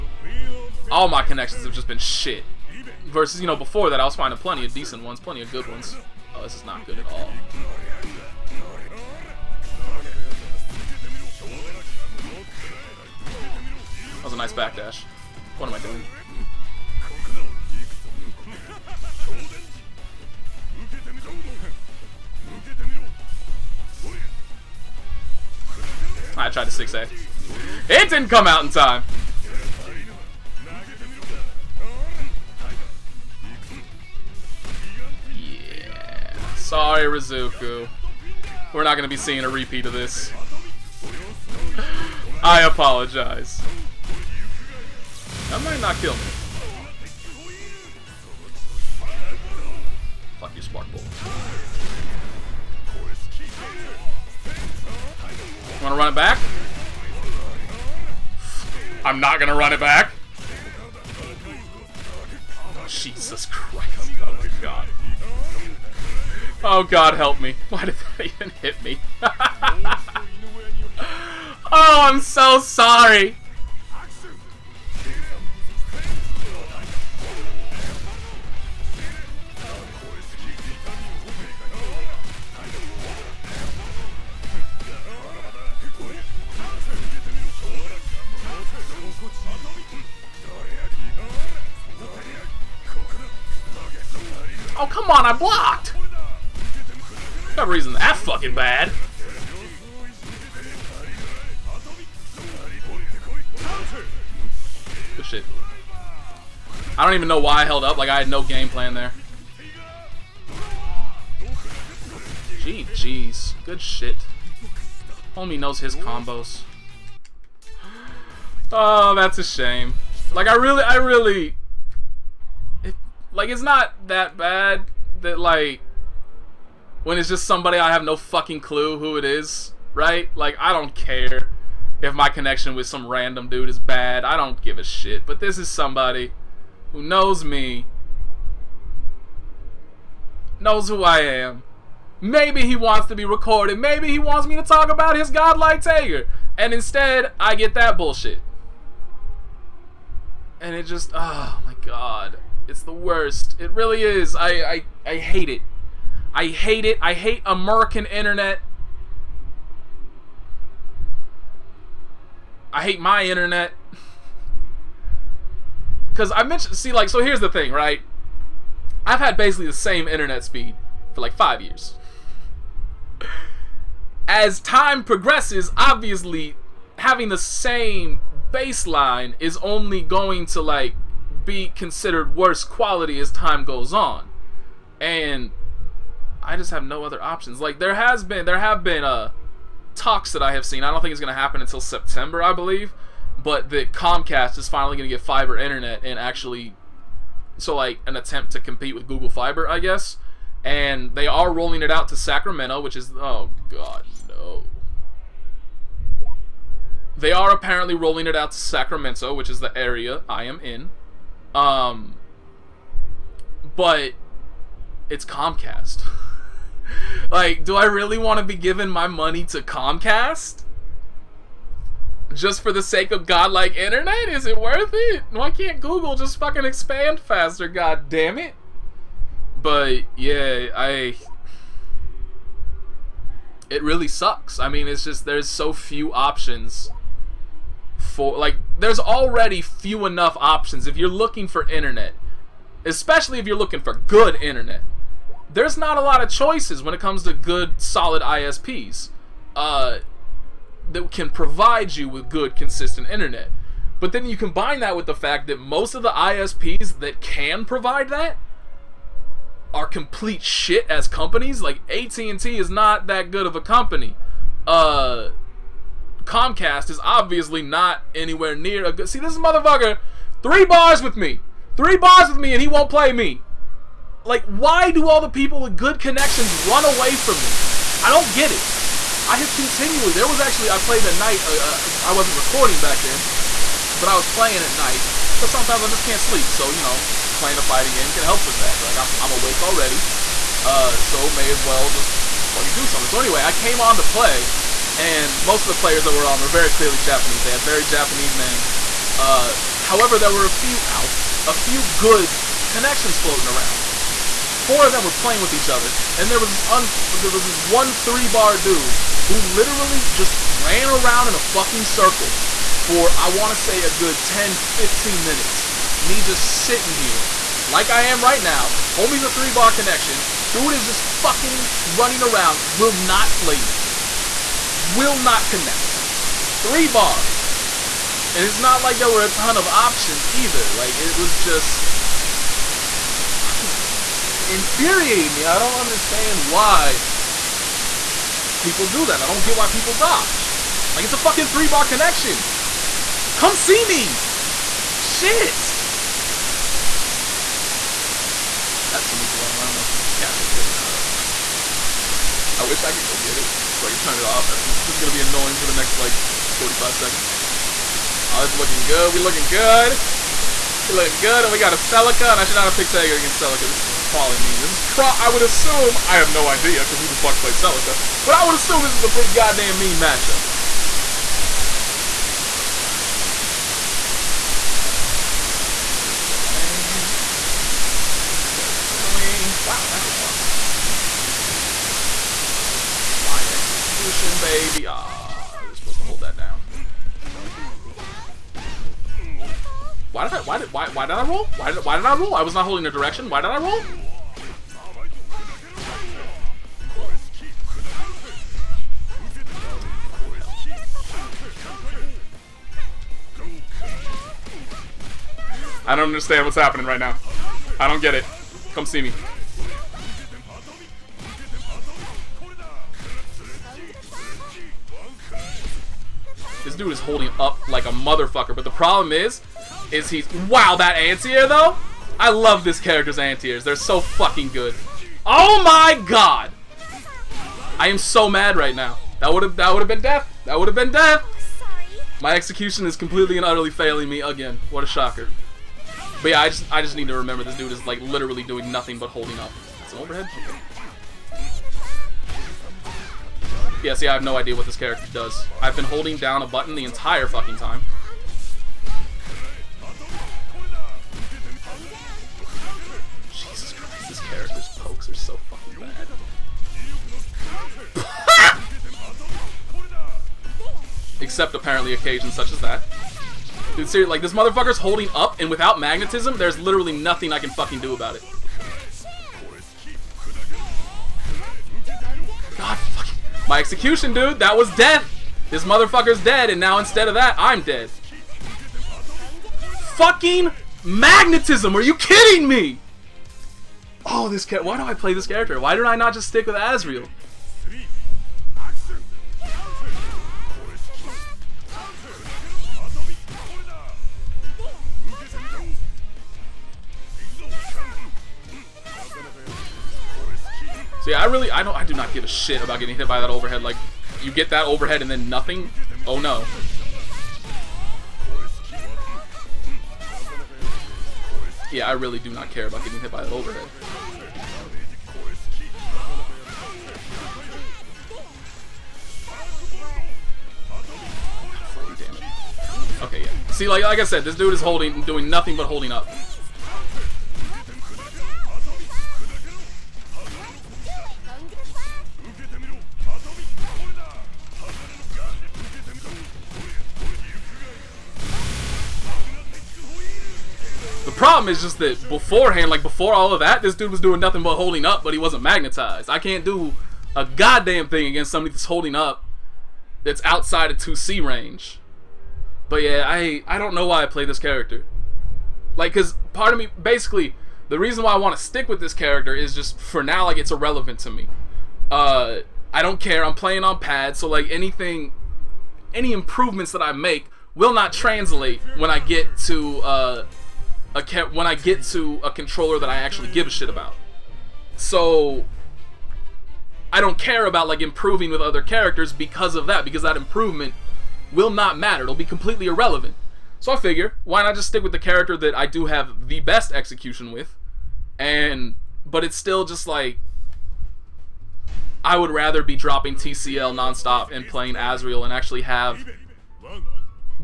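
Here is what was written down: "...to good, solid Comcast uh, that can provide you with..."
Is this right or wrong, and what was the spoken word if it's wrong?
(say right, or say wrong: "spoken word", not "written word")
wrong: "ISPs", not "Comcast".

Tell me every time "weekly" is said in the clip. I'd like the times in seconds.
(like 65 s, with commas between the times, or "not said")
not said.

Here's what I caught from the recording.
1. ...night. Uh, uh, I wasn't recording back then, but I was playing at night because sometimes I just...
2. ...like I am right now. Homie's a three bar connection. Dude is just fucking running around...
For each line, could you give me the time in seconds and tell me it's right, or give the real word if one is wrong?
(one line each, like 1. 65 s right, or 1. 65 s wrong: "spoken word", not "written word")
1. 281 s right
2. 317 s right.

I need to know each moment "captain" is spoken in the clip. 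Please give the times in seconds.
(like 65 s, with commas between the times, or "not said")
not said.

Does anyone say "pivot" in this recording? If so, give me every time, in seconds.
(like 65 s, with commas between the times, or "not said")
not said.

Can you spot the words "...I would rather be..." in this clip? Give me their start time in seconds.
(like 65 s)
592 s.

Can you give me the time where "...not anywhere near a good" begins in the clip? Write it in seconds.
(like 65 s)
267 s.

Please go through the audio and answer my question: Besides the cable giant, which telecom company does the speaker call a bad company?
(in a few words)
AT&T.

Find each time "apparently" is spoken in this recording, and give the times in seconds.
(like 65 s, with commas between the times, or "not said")
207 s, 461 s.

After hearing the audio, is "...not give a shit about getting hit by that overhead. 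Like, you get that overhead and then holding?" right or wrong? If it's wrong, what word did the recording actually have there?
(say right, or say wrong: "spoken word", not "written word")
wrong: "nothing", not "holding".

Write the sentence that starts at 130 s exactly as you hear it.
Like I don't care if my connection with some random dude is bad.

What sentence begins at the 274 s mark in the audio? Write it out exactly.
Like, why do all the people with good connections run away from me?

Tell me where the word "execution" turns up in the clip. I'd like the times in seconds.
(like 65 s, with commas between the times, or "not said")
383 s, 432 s, 473 s, 586 s.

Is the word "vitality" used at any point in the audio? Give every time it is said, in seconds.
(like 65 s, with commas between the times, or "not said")
not said.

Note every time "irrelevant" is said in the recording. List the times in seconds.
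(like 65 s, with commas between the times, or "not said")
560 s, 582 s.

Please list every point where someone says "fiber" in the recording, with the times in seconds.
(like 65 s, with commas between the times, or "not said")
195 s, 199 s.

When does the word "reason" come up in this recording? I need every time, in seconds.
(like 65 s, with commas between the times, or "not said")
97 s, 557 s.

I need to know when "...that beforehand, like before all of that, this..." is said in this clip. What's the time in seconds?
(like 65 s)
541 s.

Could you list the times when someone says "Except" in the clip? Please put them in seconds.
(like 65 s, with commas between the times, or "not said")
461 s.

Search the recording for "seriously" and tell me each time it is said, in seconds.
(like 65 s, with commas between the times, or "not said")
463 s.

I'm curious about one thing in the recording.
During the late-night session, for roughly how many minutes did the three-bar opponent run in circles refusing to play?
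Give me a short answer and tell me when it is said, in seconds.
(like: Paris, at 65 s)
10-15, at 314 s.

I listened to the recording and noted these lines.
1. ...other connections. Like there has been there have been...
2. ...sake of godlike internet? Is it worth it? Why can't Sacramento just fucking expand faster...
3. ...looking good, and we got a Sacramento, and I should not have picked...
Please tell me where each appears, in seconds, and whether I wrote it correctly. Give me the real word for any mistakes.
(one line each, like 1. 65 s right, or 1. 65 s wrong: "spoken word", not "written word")
1. 187 s wrong: "options", not "connections"
2. 222 s wrong: "Google", not "Sacramento"
3. 360 s wrong: "Celica", not "Sacramento".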